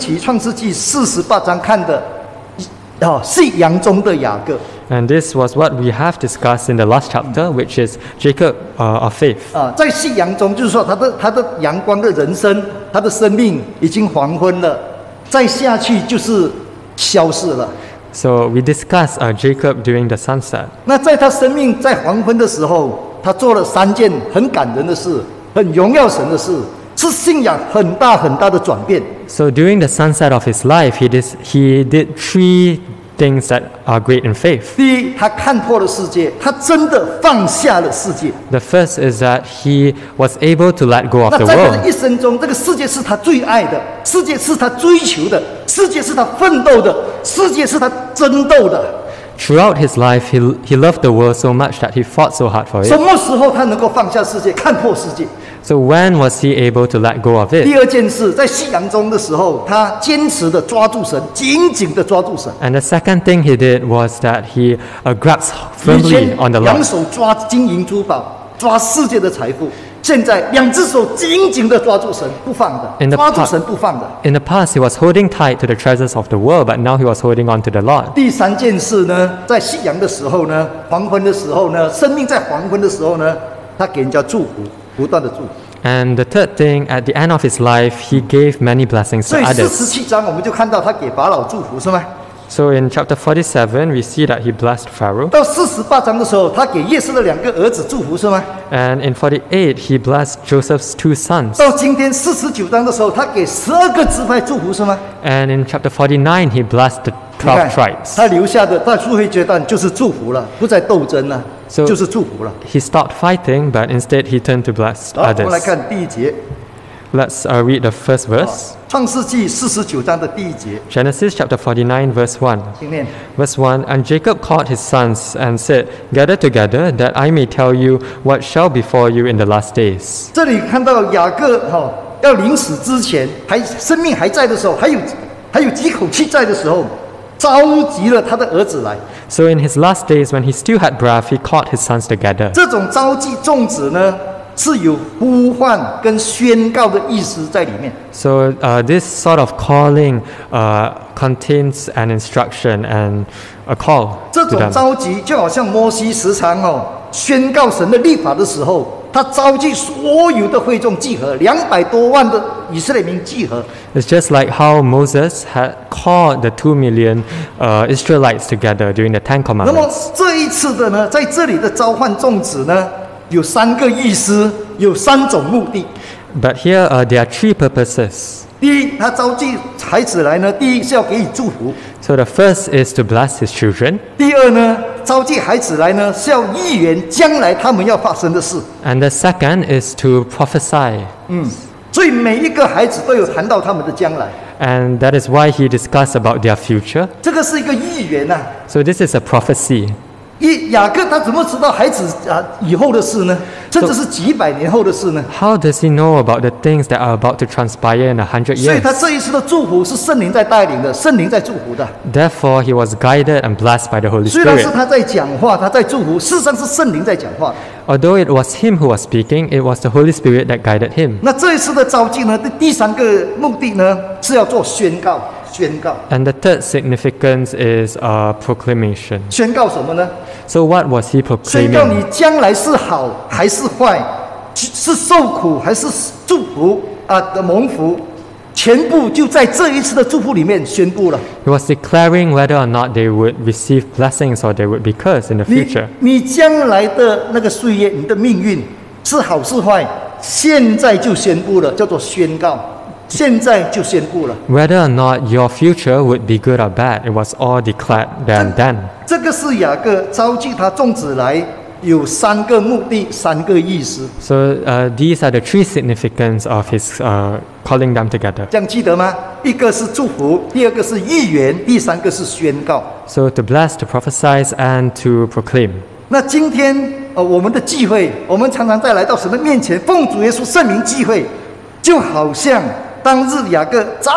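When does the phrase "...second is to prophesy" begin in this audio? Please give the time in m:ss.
3:09.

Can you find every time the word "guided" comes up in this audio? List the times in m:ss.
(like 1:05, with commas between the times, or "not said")
3:32, 3:40.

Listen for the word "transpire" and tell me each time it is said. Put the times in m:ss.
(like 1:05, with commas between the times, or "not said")
3:27.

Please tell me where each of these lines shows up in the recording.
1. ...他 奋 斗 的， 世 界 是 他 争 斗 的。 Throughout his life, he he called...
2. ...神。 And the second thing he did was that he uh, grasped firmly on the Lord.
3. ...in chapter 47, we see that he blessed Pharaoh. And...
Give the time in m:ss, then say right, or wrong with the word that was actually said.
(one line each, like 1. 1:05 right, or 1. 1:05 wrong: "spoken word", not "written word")
1. 0:46 wrong: "loved", not "called"
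2. 1:02 right
3. 1:32 right.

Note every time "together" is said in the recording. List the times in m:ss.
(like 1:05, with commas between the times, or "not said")
2:06, 2:22, 2:48, 4:28.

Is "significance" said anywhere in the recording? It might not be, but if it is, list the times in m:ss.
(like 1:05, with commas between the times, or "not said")
3:46, 4:25.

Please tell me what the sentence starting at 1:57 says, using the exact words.
Let's uh, read the first verse.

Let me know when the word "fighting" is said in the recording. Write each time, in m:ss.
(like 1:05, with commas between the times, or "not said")
1:53.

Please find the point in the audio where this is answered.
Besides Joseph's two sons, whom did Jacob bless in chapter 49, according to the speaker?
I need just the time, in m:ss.
1:47.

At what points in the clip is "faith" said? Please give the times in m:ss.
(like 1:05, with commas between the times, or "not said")
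0:09, 0:34.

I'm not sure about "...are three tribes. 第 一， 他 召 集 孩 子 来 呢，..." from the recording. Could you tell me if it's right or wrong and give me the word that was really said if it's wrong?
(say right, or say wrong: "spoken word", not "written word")
wrong: "purposes", not "tribes".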